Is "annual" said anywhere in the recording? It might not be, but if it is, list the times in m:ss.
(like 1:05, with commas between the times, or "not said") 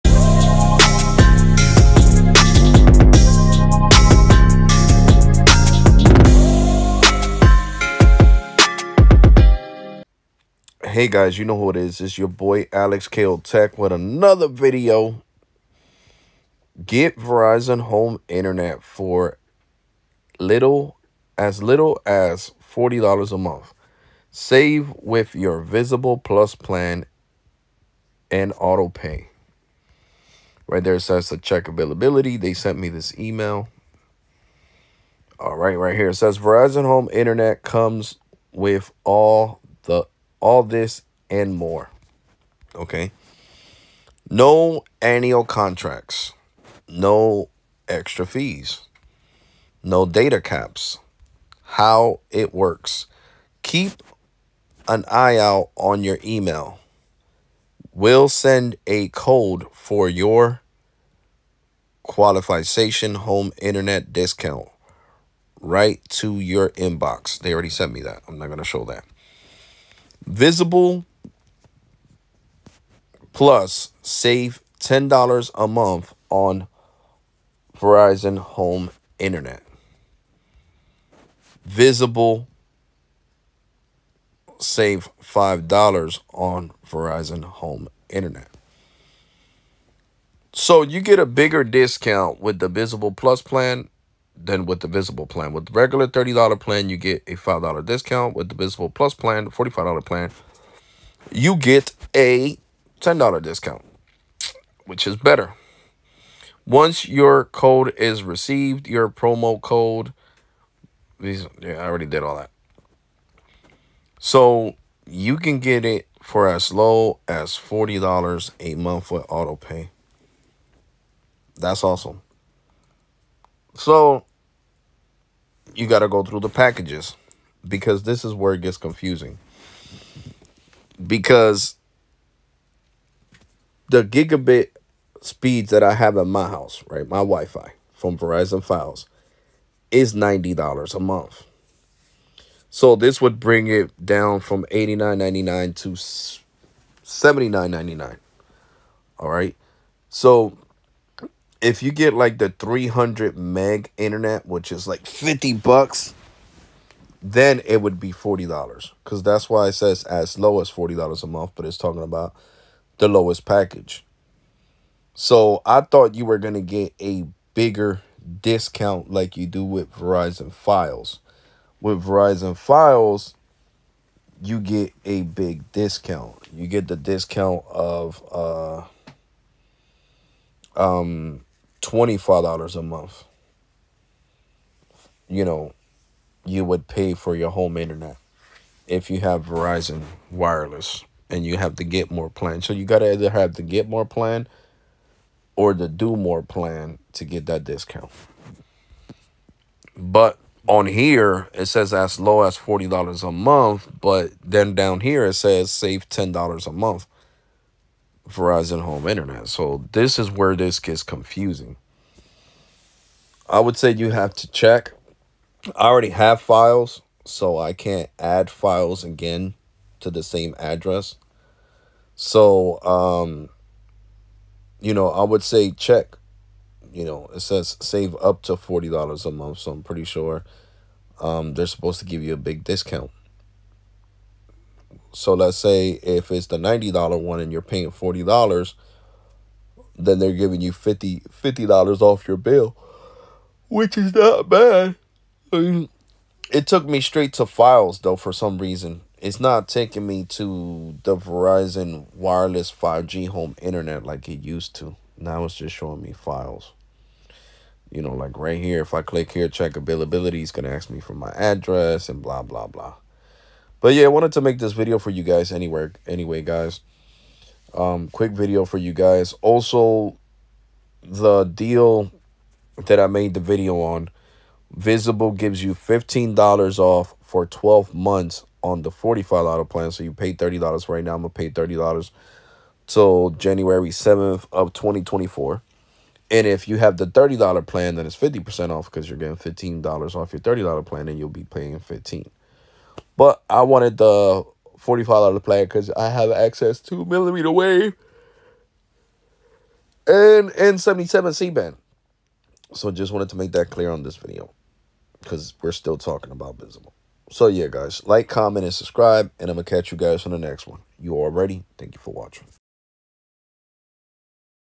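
0:45.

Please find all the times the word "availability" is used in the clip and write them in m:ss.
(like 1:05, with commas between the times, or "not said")
0:31, 4:19.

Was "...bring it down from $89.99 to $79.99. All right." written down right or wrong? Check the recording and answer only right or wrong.
right.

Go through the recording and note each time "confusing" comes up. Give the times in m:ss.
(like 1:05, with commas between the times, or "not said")
2:08, 3:31.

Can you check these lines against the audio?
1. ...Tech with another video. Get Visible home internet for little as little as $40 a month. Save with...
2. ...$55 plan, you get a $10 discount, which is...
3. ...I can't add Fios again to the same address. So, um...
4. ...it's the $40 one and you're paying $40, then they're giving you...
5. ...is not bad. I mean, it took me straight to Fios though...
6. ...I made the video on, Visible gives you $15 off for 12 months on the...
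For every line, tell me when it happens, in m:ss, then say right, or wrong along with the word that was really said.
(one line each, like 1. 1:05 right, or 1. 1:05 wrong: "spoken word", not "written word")
1. 0:13 wrong: "Verizon", not "Visible"
2. 1:39 wrong: "45", not "55"
3. 3:37 right
4. 3:56 wrong: "90", not "40"
5. 4:03 right
6. 4:32 right.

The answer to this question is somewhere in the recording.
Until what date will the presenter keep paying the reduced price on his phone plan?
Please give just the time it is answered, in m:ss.
4:43.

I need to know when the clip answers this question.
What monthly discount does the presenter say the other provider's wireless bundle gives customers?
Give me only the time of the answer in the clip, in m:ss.
3:01.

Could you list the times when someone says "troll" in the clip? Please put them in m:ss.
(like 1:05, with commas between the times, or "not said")
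not said.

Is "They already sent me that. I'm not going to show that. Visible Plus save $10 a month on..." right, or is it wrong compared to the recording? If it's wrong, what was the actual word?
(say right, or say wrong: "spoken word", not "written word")
right.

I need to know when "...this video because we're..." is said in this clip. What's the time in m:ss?
5:04.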